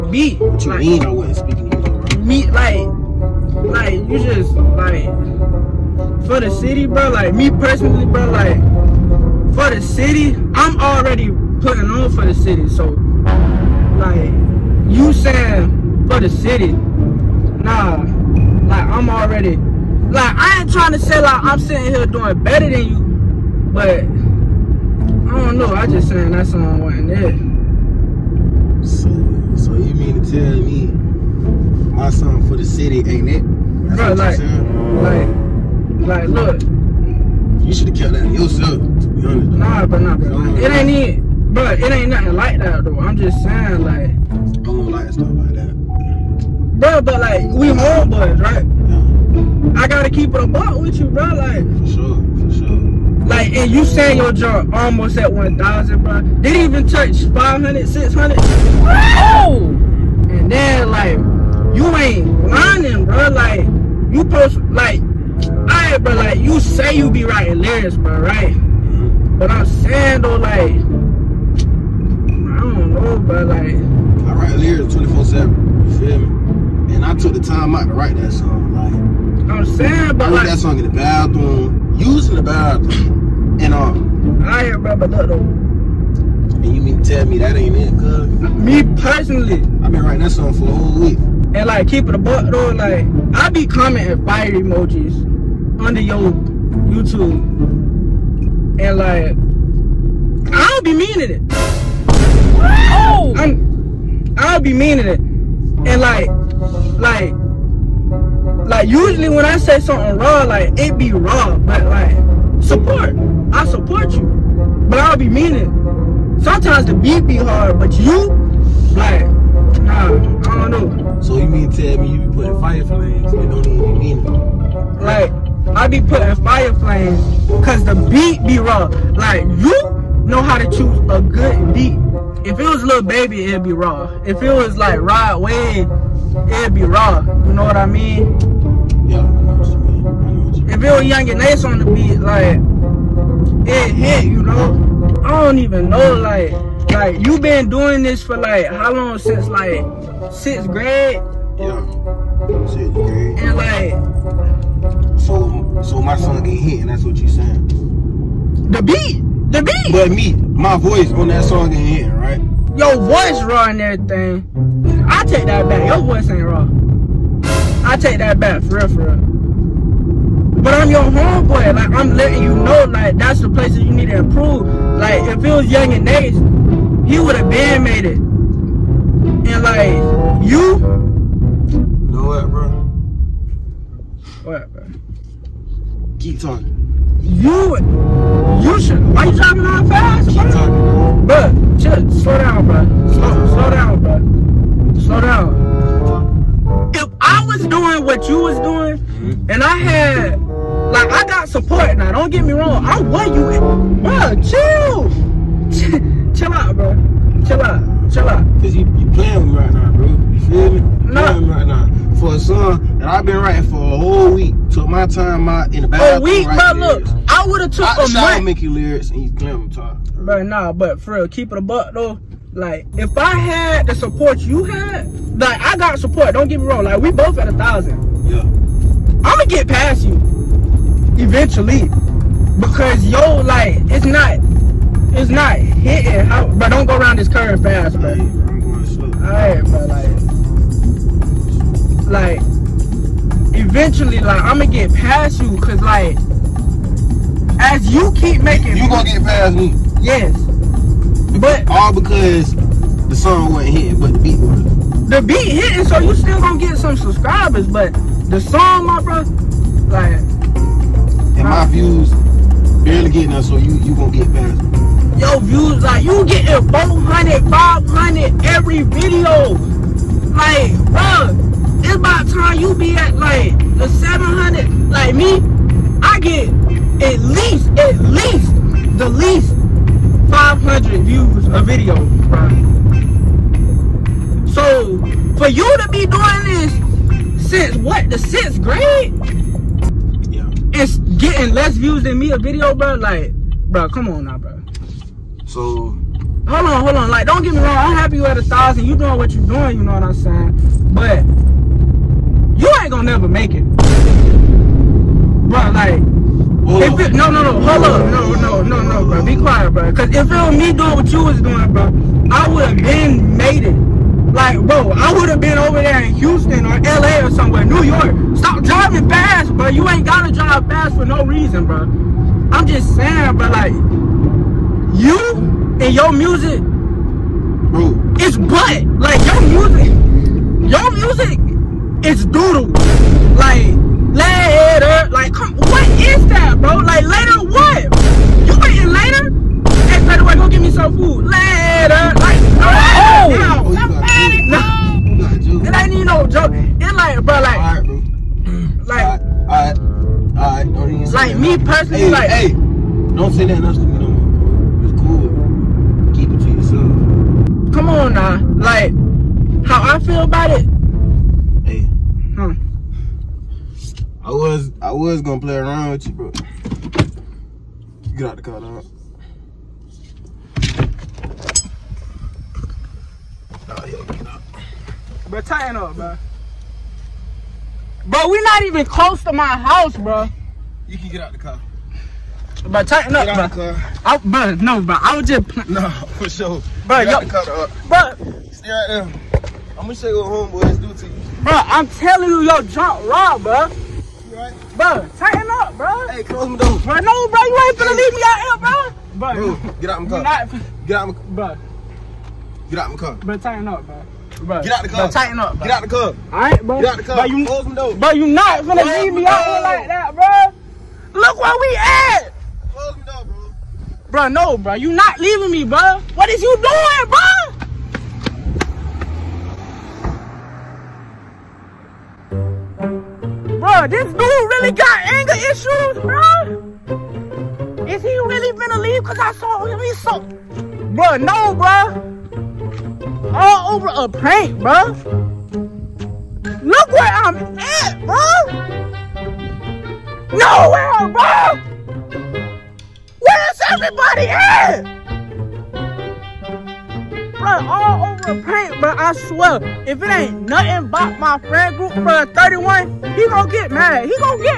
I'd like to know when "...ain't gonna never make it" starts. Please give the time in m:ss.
5:02.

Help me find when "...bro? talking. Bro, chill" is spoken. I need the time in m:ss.
3:10.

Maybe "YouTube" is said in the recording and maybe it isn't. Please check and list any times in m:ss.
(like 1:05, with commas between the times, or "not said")
1:36.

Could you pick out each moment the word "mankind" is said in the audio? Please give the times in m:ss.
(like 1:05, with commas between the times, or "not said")
not said.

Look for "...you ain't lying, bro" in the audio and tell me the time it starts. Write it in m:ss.
1:01.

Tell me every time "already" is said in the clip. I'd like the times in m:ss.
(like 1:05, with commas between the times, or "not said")
0:10, 0:19.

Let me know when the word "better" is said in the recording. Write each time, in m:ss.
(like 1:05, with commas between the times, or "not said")
0:22, 5:40.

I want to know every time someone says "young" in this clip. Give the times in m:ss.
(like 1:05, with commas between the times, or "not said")
2:21, 2:55.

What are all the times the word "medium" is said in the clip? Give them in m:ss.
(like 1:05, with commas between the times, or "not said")
not said.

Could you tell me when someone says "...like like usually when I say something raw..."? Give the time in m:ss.
1:46.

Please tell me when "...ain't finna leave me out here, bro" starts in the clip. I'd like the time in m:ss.
6:37.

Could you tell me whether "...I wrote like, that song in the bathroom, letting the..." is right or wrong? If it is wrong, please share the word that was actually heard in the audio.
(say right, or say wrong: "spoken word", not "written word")
wrong: "using", not "letting".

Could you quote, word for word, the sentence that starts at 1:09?
But I'm saying, though, like, I don't know, bro.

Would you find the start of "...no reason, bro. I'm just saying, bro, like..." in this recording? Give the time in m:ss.
5:21.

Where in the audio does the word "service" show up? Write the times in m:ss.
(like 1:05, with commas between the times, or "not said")
not said.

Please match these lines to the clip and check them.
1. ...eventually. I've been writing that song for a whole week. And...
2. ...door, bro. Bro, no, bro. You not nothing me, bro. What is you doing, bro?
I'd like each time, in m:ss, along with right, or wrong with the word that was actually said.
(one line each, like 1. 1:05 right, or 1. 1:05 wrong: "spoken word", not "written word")
1. 1:29 wrong: "personally", not "eventually"
2. 6:53 wrong: "leaving", not "nothing".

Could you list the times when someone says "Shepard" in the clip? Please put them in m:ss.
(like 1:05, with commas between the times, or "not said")
not said.